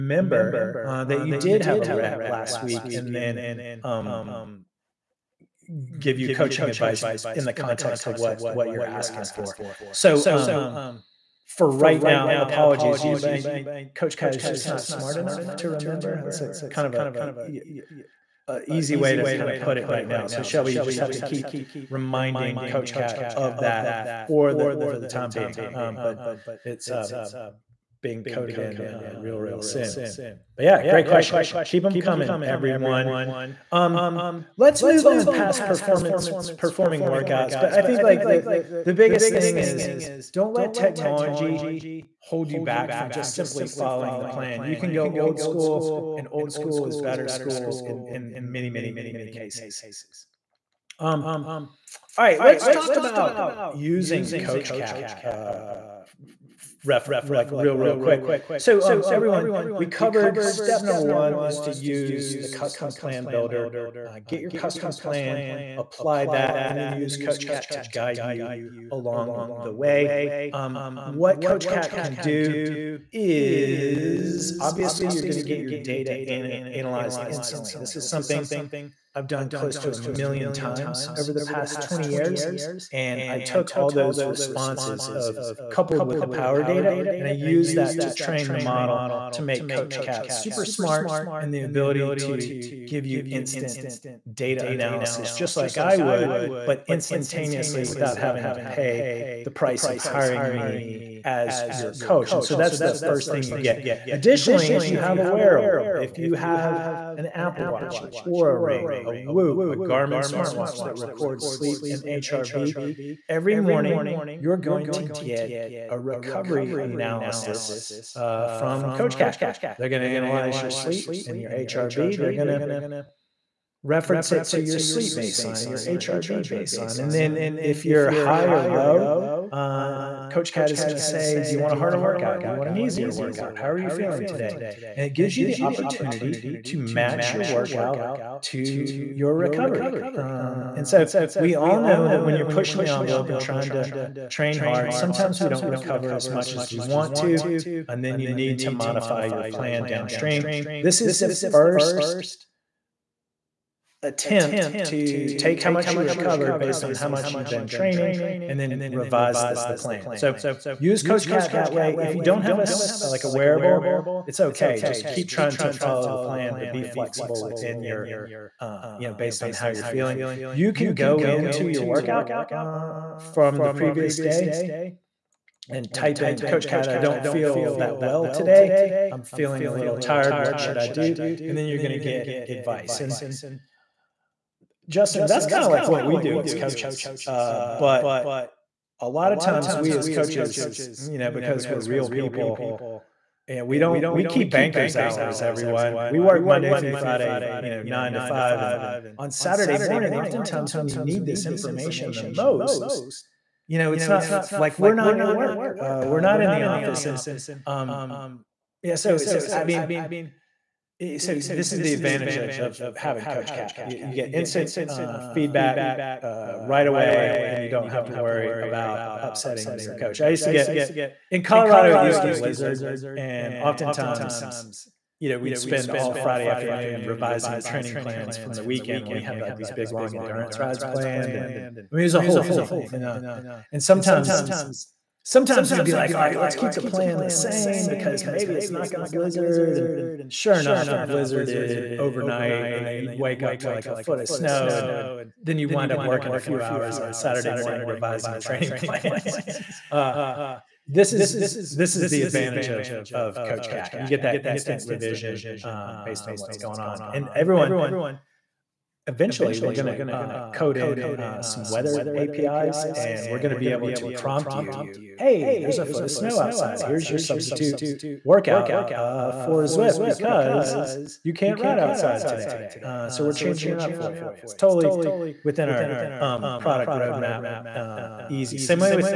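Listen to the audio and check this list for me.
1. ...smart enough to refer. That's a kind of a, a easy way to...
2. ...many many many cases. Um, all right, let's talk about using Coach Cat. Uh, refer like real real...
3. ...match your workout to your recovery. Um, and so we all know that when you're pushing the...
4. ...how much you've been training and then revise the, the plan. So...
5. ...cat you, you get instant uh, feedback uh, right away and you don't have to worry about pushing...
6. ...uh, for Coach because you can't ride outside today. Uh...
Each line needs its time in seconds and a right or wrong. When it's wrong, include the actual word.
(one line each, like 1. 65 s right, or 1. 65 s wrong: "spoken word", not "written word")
1. 14 s wrong: "remember", not "refer"
2. 48 s right
3. 136 s right
4. 156 s right
5. 213 s wrong: "upsetting", not "pushing"
6. 268 s wrong: "Zwift", not "Coach".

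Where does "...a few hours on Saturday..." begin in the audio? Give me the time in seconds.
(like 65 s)
246 s.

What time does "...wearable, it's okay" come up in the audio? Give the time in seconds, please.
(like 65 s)
163 s.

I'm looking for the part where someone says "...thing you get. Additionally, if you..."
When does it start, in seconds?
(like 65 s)
103 s.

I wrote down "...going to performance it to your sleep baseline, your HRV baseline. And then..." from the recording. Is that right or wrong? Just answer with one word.
wrong.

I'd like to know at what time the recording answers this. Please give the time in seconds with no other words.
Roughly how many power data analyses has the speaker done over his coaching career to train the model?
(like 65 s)
79 s.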